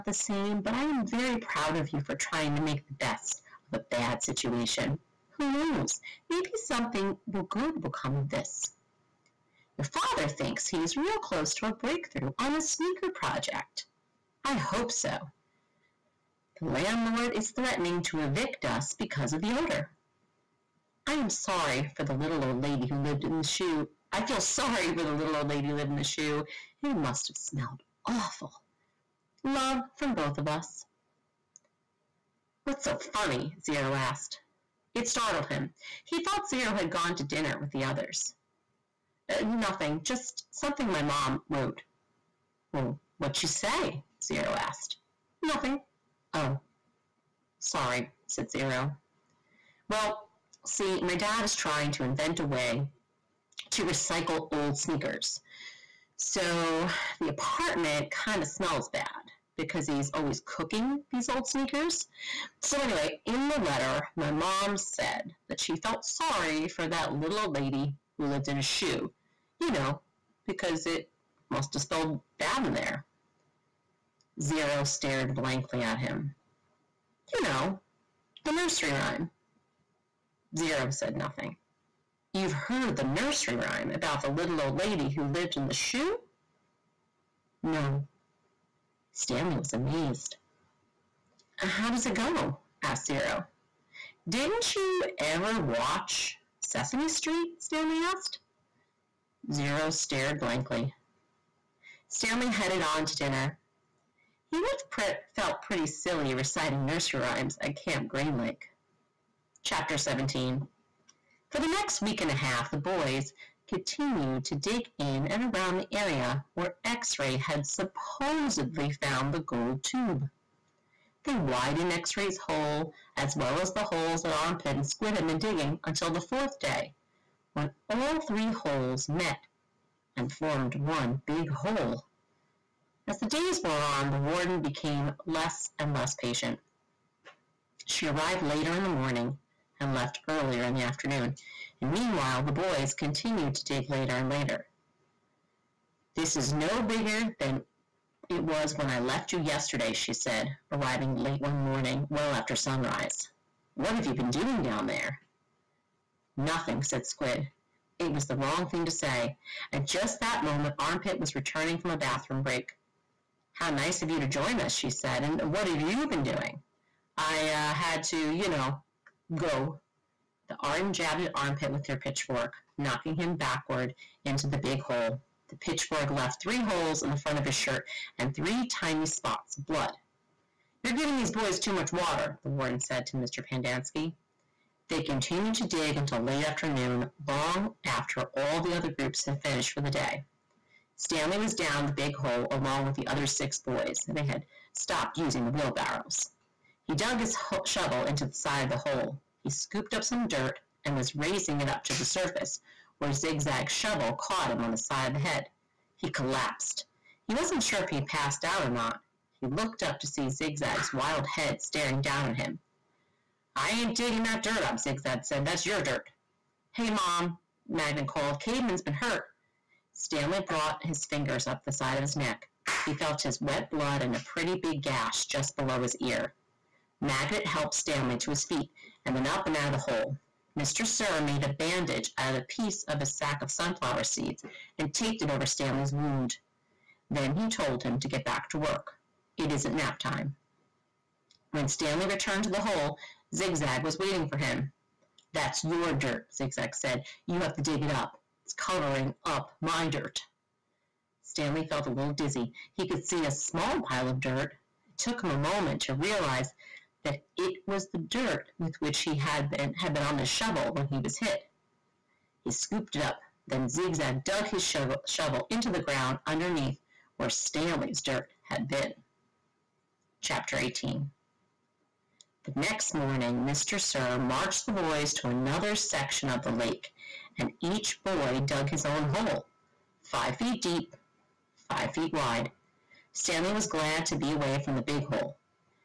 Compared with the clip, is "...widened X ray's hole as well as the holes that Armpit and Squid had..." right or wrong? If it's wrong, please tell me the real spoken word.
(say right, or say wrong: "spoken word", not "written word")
right.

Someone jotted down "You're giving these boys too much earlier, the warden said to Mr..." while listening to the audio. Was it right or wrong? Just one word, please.
wrong.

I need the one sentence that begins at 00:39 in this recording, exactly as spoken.
Uh, nothing, just something my mom wrote.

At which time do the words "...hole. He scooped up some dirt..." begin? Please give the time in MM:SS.
03:18.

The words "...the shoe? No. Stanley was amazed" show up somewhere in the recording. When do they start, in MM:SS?
01:25.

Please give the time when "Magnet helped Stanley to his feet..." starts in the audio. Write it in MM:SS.
03:47.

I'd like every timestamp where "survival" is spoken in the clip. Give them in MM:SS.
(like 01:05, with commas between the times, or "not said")
not said.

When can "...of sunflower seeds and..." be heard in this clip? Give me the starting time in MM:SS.
03:53.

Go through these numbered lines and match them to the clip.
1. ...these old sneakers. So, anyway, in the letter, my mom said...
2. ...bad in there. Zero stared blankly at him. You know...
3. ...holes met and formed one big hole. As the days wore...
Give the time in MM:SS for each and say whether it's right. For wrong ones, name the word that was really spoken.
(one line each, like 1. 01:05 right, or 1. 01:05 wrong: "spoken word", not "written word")
1. 01:01 right
2. 01:12 right
3. 02:08 right.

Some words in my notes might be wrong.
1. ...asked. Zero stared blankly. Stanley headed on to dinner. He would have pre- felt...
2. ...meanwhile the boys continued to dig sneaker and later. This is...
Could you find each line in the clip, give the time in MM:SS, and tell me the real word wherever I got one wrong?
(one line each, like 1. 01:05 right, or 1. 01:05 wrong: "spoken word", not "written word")
1. 01:38 right
2. 02:21 wrong: "later", not "sneaker".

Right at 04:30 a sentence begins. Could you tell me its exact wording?
Chapter 18 the next morning Mr.